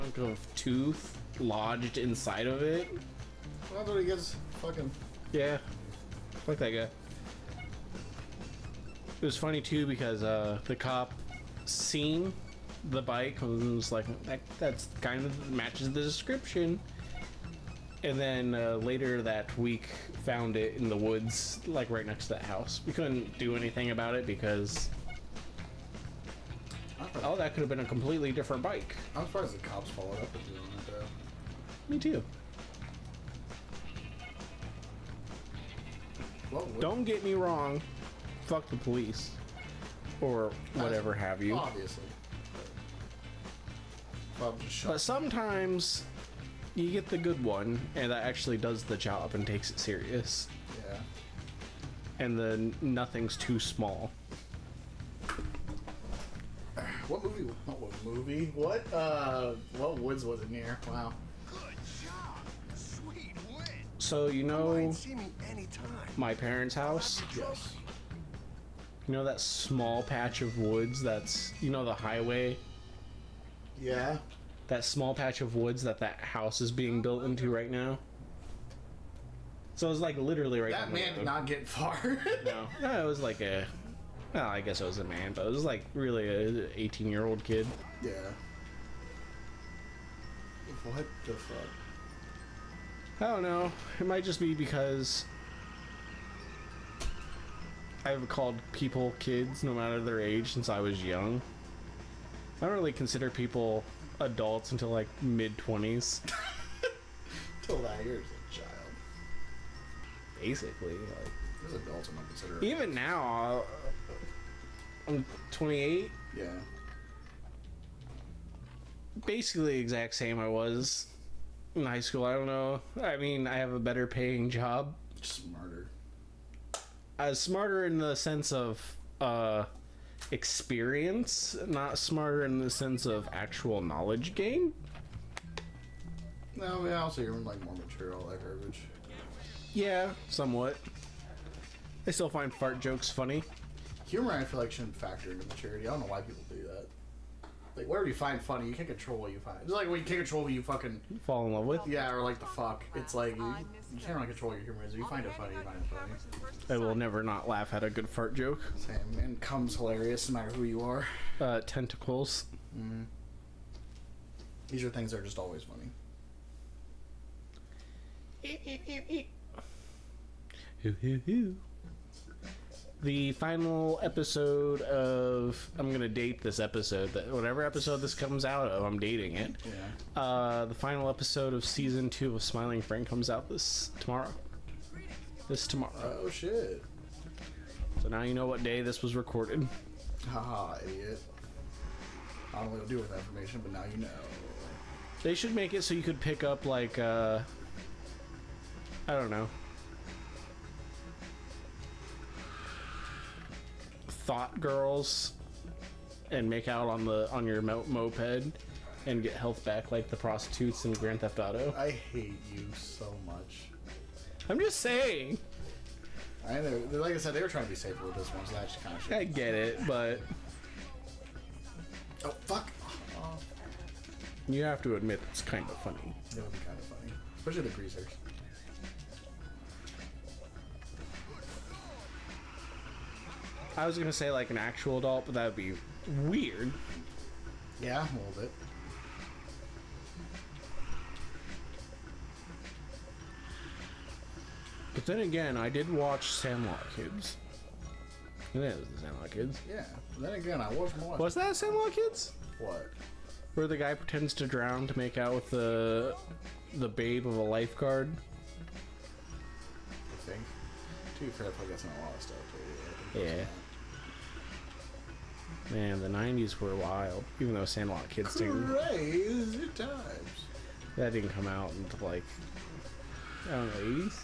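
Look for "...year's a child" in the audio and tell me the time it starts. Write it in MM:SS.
01:48.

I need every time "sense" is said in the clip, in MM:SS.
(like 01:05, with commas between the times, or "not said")
02:08, 02:12.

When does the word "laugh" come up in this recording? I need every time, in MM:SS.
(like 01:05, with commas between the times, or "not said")
02:37.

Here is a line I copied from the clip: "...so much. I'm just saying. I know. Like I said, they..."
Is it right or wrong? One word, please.
right.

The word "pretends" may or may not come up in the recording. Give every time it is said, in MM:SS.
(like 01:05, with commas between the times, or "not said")
04:13.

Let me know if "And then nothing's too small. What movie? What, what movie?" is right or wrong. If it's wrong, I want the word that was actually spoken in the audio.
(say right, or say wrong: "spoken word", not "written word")
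right.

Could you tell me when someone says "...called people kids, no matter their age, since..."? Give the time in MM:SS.
01:38.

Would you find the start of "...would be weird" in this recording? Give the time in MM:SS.
03:55.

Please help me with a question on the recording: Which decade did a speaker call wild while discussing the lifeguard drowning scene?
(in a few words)
the 90s.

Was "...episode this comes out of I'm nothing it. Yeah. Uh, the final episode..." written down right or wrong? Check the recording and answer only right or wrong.
wrong.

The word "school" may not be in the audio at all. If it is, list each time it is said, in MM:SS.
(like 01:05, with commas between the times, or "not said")
02:01.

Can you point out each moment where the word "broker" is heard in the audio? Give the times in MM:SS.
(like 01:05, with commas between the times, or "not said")
not said.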